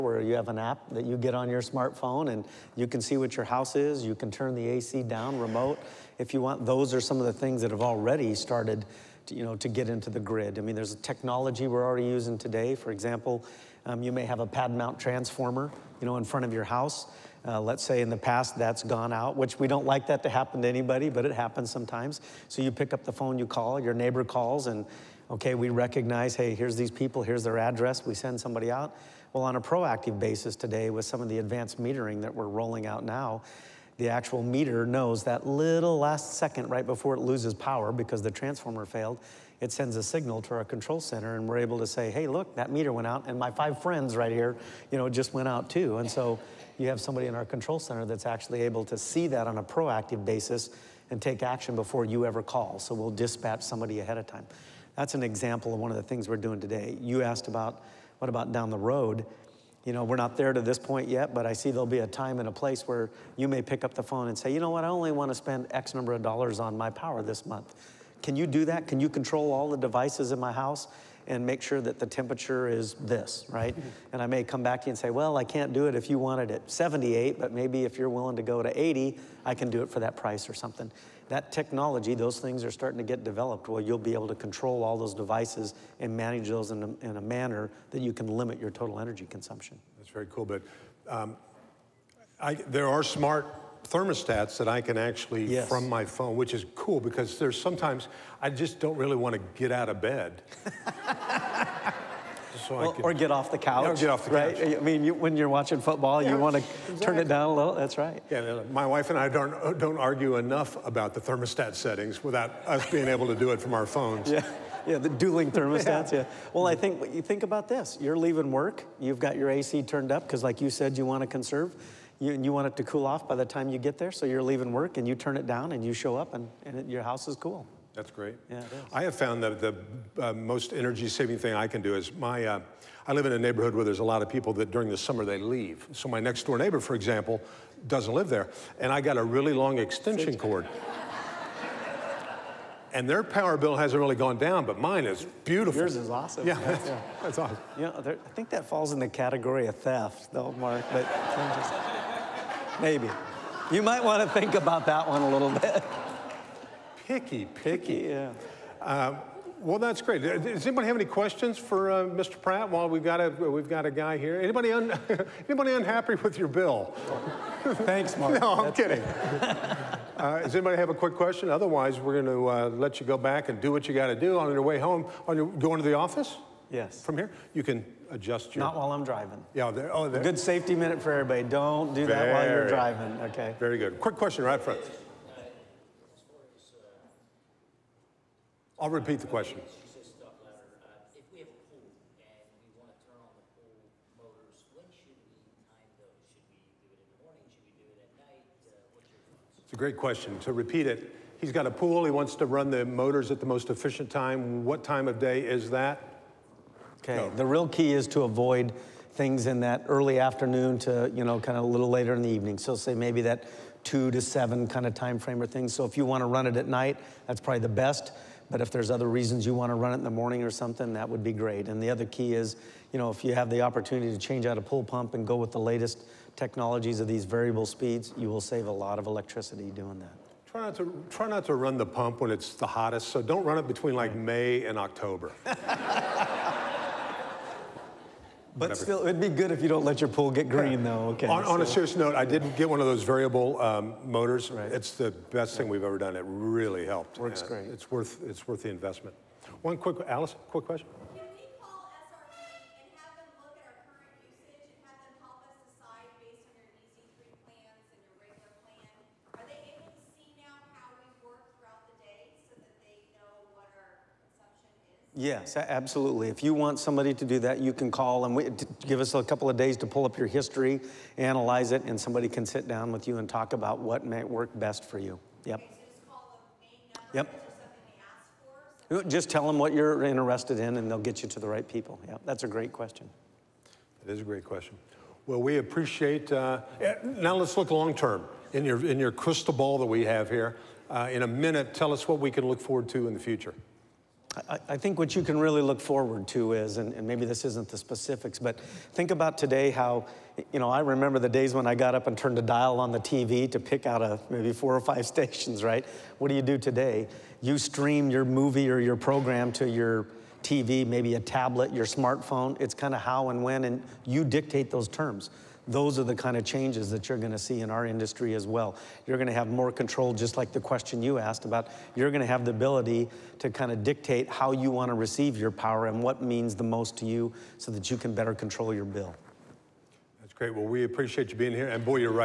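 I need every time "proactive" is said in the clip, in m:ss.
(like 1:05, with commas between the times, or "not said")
0:29, 0:49.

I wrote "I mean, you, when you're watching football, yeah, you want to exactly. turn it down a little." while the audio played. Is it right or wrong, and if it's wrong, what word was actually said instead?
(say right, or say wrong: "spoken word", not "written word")
right.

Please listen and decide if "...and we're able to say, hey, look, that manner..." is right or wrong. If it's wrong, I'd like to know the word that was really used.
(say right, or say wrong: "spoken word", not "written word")
wrong: "meter", not "manner".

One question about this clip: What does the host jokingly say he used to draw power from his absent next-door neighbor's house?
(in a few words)
long extension cord.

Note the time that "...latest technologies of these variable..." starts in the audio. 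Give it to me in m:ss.
3:45.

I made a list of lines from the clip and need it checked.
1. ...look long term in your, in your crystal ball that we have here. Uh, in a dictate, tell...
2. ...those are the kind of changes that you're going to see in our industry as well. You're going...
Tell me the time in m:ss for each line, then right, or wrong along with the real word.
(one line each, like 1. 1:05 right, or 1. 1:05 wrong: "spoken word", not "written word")
1. 4:47 wrong: "minute", not "dictate"
2. 5:15 right.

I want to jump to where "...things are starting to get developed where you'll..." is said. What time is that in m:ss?
1:22.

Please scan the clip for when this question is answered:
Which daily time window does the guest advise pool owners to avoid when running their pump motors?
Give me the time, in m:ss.
3:33.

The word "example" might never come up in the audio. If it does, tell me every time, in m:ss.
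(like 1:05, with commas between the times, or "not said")
0:12, 0:55, 2:16.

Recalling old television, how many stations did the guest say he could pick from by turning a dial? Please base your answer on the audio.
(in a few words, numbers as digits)
4 or 5.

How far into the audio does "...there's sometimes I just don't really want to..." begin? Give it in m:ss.
1:37.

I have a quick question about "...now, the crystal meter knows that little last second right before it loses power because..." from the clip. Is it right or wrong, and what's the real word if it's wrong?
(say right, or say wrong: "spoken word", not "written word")
wrong: "actual", not "crystal".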